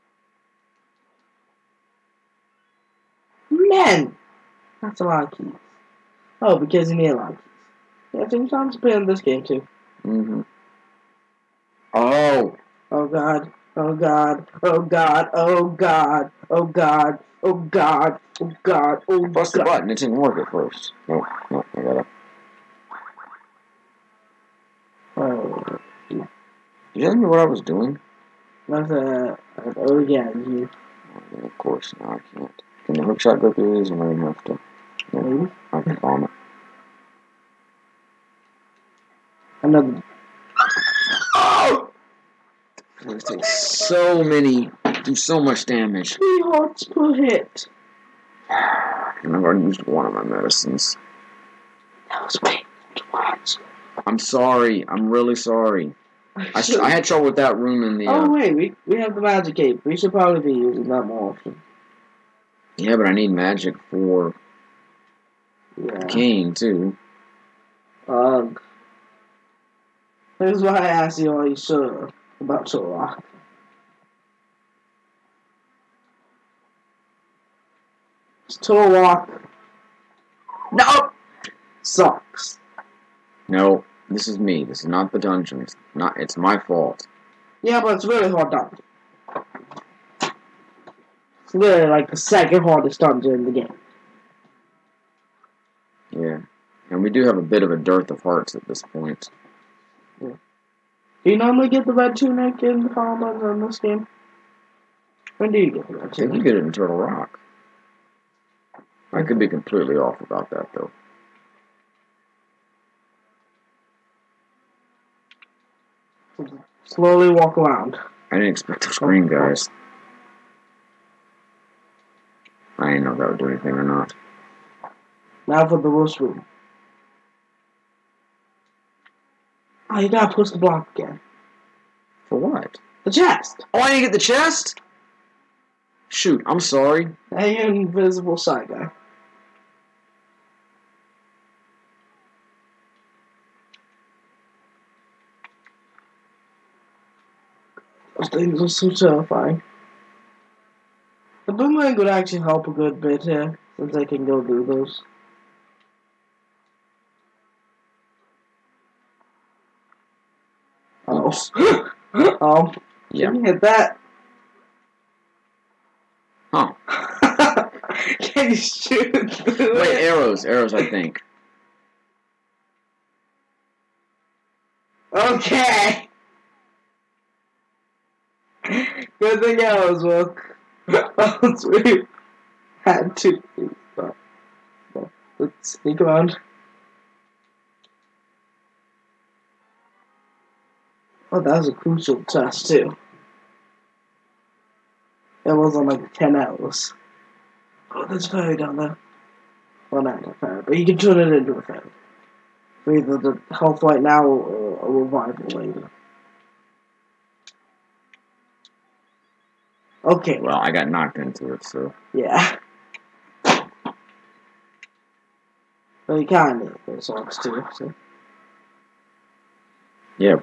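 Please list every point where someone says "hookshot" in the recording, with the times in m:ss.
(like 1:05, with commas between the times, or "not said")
0:33.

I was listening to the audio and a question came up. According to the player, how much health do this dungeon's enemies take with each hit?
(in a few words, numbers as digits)
3 hearts.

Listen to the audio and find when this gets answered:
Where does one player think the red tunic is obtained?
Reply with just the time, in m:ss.
1:46.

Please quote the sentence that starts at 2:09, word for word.
Oh, you gotta push the block again.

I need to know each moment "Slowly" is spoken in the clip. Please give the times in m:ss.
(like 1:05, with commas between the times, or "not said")
1:56.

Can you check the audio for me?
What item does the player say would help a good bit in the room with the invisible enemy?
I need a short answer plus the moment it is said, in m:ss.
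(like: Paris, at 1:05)
boomerang, at 2:31.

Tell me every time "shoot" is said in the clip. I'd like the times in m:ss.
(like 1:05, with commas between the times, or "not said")
2:16, 2:48.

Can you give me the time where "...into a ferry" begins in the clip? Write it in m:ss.
3:21.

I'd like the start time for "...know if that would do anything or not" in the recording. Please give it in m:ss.
2:03.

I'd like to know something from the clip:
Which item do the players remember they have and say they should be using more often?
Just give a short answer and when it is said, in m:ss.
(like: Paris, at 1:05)
magic cape, at 0:59.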